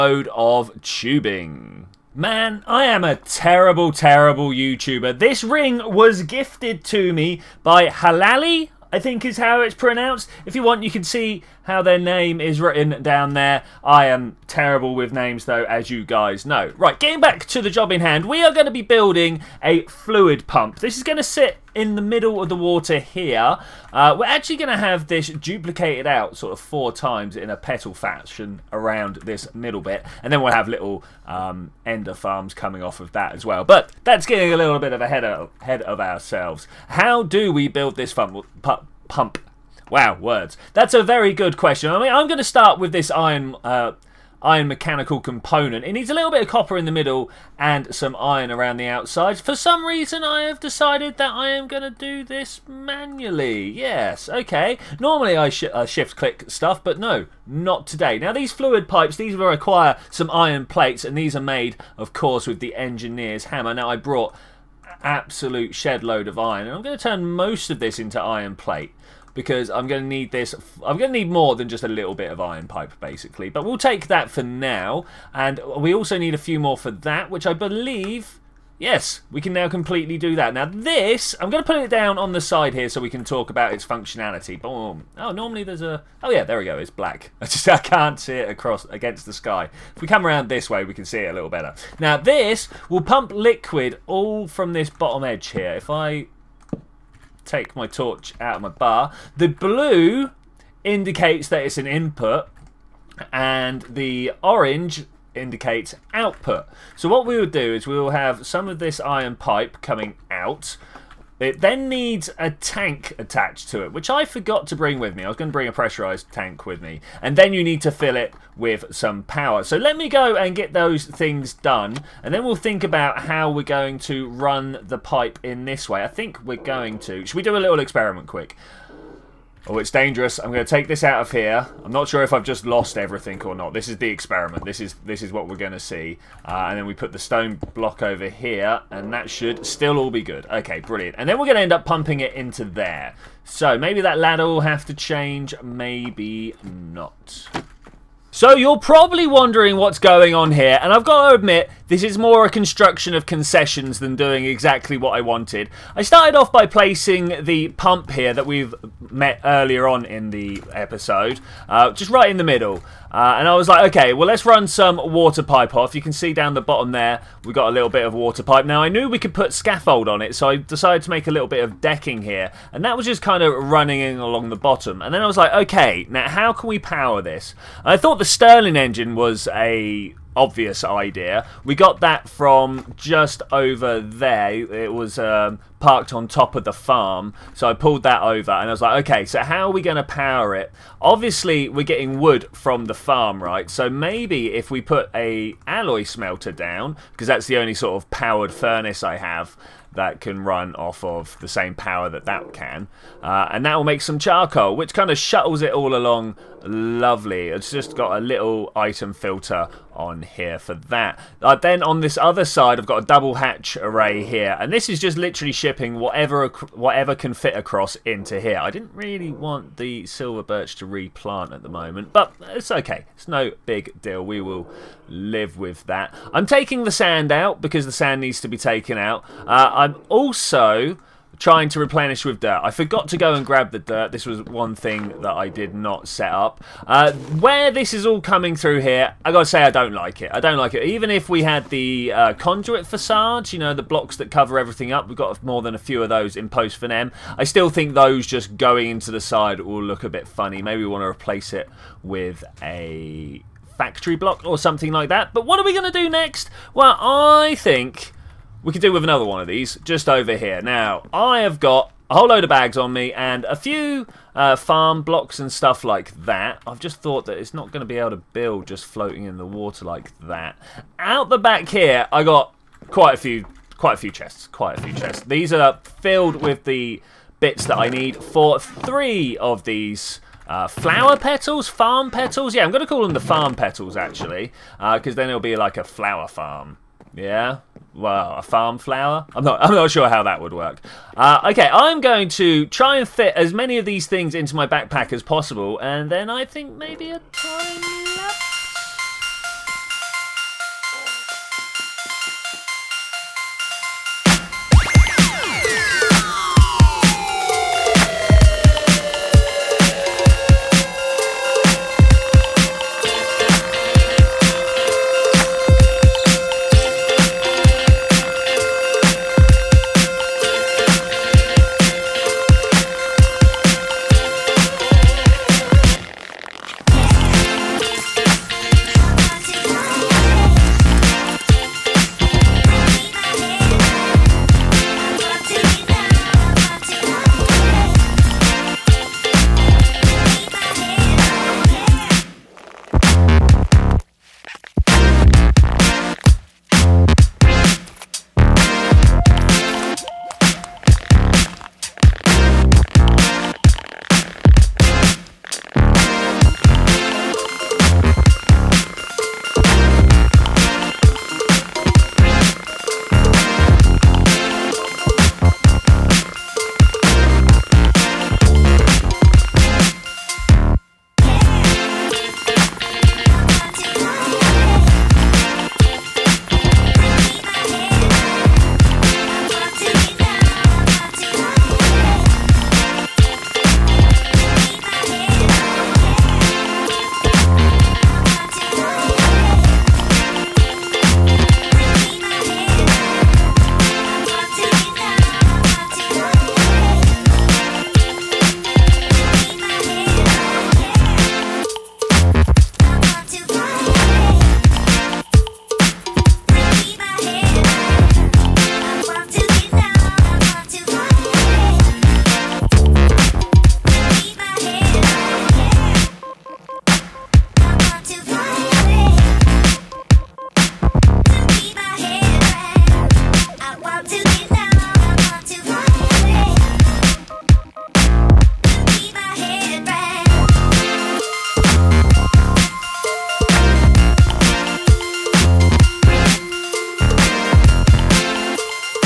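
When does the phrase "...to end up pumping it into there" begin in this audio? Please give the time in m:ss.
2:21.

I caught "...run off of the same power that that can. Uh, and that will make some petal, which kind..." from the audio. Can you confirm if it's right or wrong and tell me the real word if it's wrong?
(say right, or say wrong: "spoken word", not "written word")
wrong: "charcoal", not "petal".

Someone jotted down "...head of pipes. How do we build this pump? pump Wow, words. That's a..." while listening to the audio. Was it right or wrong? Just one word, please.
wrong.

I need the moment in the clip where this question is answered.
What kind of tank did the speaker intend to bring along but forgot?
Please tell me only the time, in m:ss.
1:55.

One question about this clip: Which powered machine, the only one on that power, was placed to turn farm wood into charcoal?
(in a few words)
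Alloy smelter.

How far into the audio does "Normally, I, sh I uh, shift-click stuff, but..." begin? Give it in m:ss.
0:54.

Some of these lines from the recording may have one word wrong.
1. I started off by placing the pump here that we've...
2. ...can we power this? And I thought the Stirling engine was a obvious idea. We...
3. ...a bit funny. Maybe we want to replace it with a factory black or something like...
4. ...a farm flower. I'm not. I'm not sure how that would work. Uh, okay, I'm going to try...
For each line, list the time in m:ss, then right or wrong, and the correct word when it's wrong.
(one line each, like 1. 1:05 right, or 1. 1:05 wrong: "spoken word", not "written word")
1. 2:35 right
2. 2:56 right
3. 4:10 wrong: "block", not "black"
4. 4:48 right.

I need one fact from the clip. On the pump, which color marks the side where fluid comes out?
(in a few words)
Orange.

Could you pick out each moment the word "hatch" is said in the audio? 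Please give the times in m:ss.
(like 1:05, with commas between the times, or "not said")
3:33.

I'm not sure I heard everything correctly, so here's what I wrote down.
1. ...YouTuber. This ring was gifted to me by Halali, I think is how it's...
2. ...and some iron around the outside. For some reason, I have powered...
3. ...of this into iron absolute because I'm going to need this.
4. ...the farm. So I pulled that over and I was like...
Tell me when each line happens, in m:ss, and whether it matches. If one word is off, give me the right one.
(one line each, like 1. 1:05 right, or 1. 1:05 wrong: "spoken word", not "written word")
1. 0:04 right
2. 0:47 wrong: "decided", not "powered"
3. 1:07 wrong: "plate", not "absolute"
4. 3:06 right.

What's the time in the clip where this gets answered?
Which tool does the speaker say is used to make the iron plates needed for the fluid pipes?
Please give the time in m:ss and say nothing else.
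1:02.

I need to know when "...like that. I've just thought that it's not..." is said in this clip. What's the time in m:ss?
4:25.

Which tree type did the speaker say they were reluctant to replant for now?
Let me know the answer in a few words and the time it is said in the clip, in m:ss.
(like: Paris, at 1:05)
Silver birch, at 3:40.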